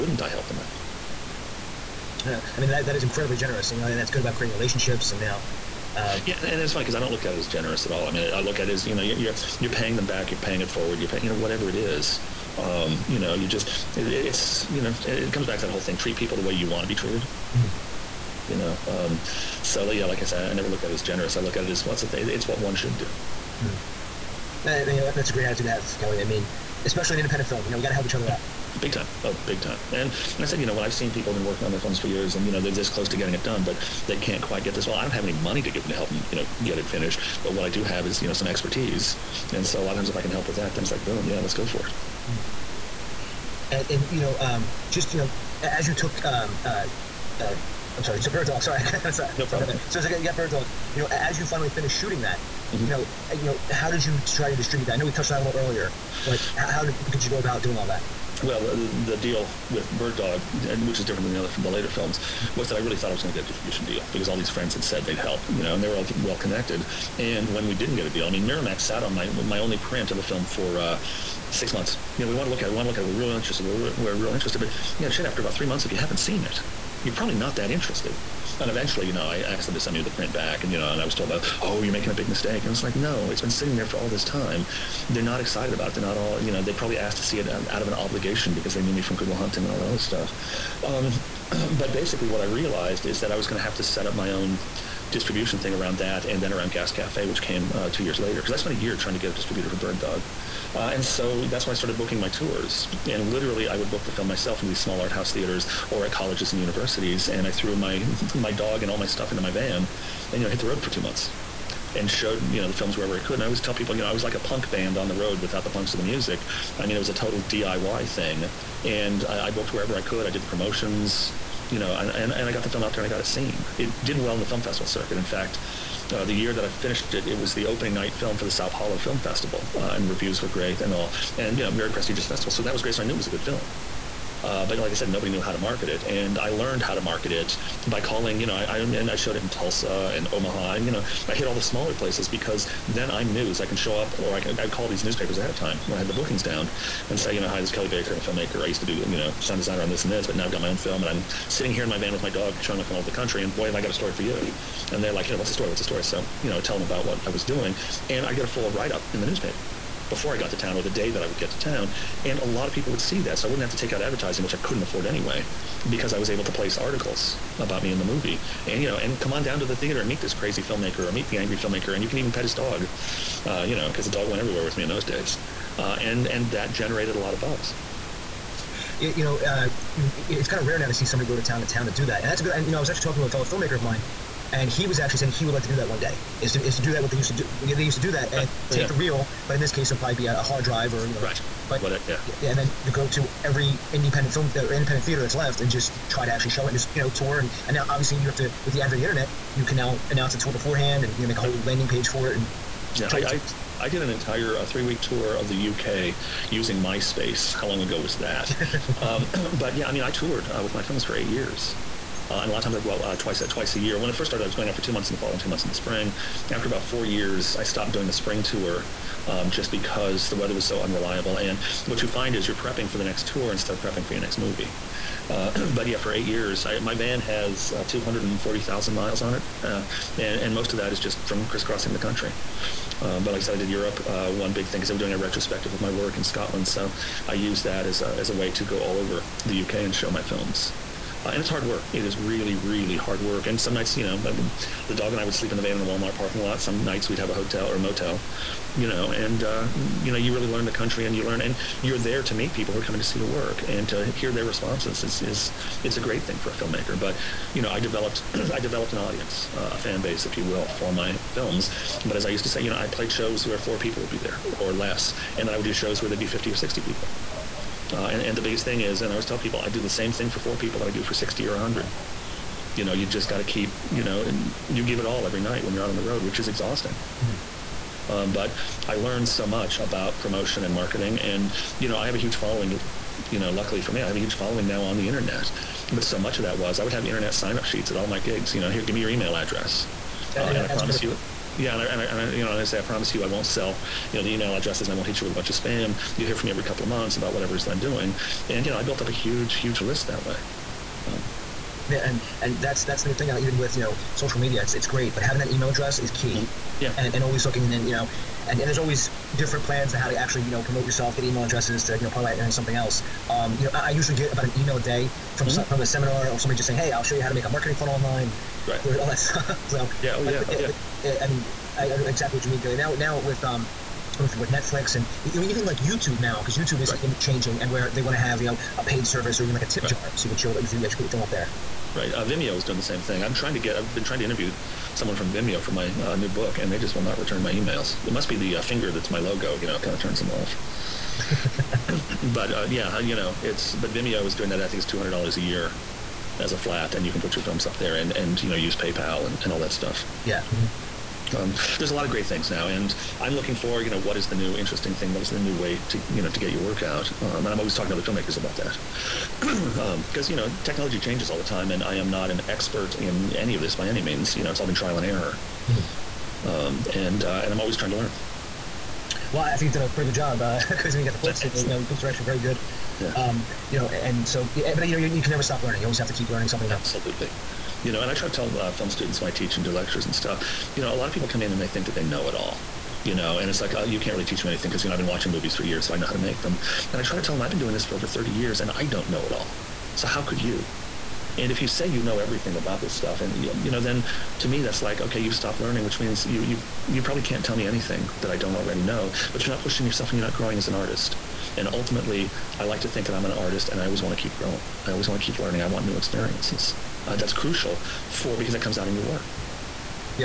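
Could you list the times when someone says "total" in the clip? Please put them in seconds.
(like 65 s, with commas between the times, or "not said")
117 s.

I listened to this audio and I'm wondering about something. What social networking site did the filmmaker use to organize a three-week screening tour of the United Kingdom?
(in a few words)
MySpace.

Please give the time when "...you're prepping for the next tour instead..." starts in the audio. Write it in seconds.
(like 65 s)
222 s.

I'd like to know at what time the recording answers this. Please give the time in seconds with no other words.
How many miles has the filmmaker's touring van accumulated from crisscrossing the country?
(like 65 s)
227 s.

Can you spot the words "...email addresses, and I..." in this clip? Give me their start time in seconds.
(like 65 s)
294 s.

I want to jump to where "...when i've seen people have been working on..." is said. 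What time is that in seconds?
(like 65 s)
30 s.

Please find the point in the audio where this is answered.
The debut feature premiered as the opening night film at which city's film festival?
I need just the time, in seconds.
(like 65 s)
128 s.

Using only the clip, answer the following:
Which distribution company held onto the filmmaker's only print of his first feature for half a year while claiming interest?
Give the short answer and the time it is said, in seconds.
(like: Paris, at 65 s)
Miramax, at 68 s.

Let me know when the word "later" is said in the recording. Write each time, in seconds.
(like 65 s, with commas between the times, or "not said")
61 s, 98 s.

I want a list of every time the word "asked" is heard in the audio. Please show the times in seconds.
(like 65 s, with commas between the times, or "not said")
79 s, 86 s.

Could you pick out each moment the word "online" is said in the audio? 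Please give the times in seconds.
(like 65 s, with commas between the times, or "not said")
317 s.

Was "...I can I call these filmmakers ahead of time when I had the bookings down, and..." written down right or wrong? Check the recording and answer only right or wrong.
wrong.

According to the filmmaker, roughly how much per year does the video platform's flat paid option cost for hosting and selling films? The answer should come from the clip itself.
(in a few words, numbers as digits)
$200.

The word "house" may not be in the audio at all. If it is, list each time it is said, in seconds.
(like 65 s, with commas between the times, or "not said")
105 s.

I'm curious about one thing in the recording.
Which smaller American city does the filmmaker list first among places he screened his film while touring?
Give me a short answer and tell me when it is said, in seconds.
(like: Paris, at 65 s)
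Tulsa, at 139 s.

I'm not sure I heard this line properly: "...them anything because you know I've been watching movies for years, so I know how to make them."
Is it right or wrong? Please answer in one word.
right.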